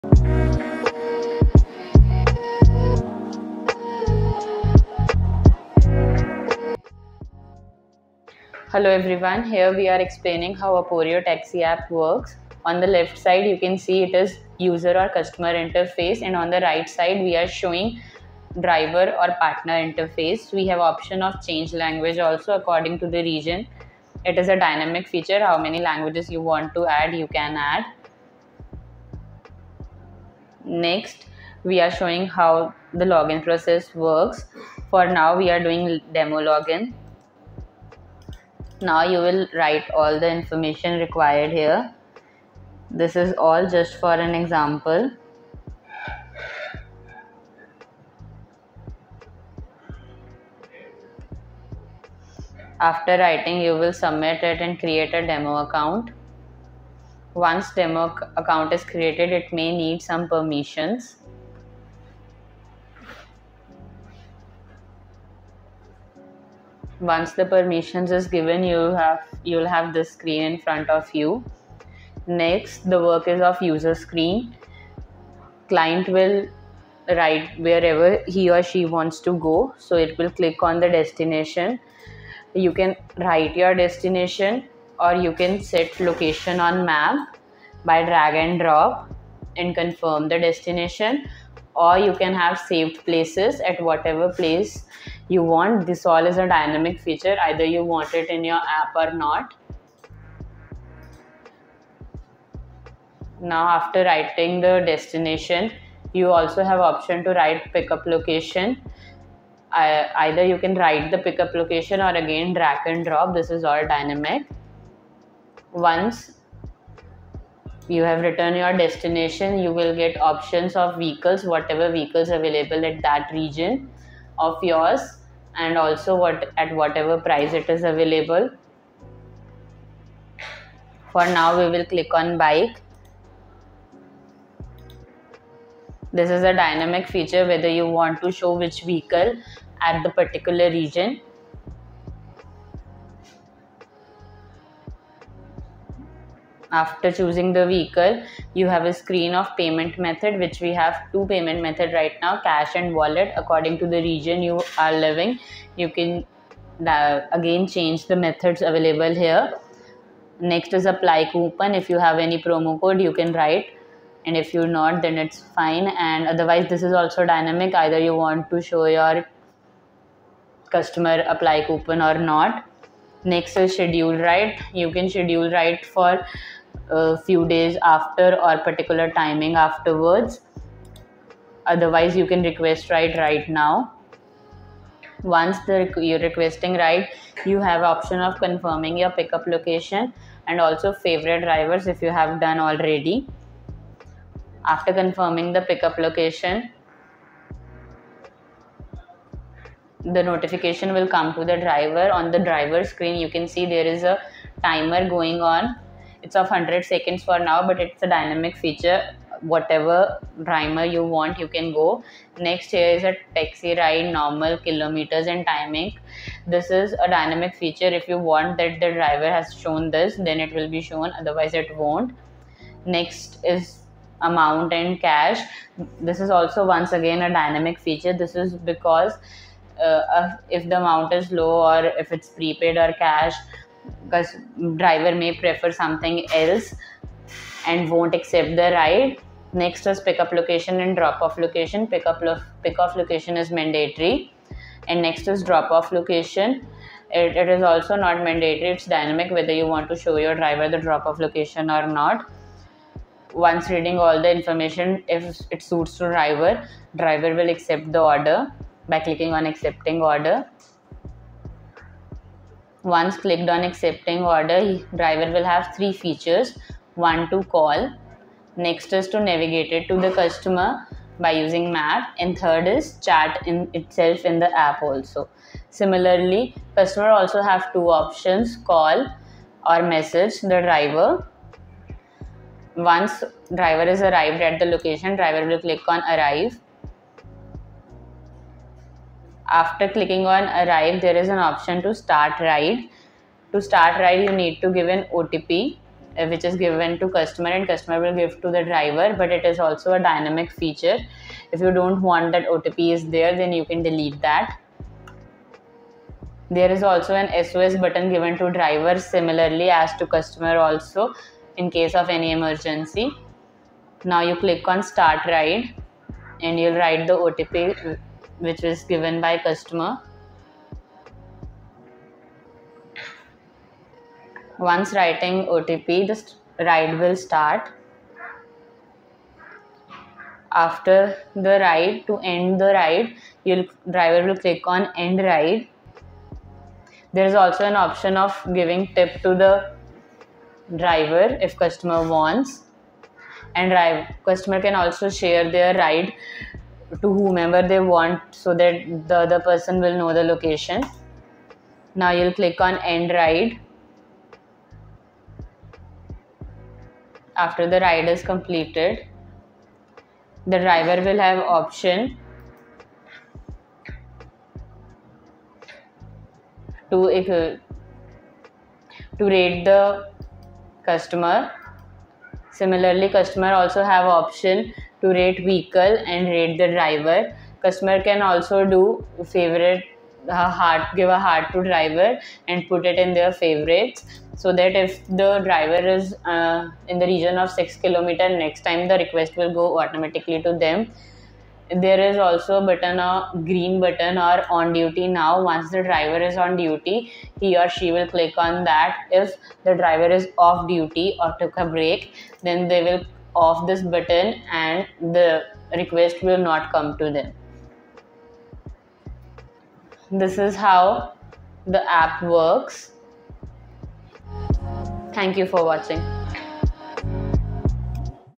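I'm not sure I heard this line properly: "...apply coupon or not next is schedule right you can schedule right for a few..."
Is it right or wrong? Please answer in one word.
right.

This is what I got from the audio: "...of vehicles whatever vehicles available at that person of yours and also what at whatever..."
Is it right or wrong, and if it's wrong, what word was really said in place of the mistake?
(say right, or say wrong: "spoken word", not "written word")
wrong: "region", not "person".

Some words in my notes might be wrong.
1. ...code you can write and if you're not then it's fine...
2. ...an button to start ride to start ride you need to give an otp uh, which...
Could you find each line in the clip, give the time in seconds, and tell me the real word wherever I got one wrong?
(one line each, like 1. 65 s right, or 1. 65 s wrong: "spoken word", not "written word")
1. 162 s right
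2. 291 s wrong: "option", not "button".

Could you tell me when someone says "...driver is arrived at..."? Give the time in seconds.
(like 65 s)
283 s.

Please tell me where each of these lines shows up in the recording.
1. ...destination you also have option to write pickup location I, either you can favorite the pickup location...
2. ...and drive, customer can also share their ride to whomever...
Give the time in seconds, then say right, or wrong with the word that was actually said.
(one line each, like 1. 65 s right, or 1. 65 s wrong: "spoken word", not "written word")
1. 104 s wrong: "write", not "favorite"
2. 343 s right.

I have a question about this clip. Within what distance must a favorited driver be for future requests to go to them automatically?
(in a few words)
6 kilometers.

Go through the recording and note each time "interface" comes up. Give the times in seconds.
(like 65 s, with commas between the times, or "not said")
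15 s, 19 s.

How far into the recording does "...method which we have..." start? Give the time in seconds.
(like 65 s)
149 s.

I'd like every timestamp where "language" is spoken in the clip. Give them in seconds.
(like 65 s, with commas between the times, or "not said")
21 s, 25 s.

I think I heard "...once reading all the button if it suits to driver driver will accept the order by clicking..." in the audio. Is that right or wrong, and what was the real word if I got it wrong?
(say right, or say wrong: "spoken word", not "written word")
wrong: "information", not "button".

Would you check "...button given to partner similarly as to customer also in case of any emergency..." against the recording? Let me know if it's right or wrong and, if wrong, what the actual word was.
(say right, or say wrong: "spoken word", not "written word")
wrong: "driver", not "partner".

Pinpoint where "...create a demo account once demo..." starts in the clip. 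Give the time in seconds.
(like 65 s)
54 s.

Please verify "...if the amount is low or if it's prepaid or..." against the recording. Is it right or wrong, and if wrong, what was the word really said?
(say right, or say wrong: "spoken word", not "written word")
right.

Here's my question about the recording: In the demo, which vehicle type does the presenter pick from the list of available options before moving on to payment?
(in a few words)
Bike.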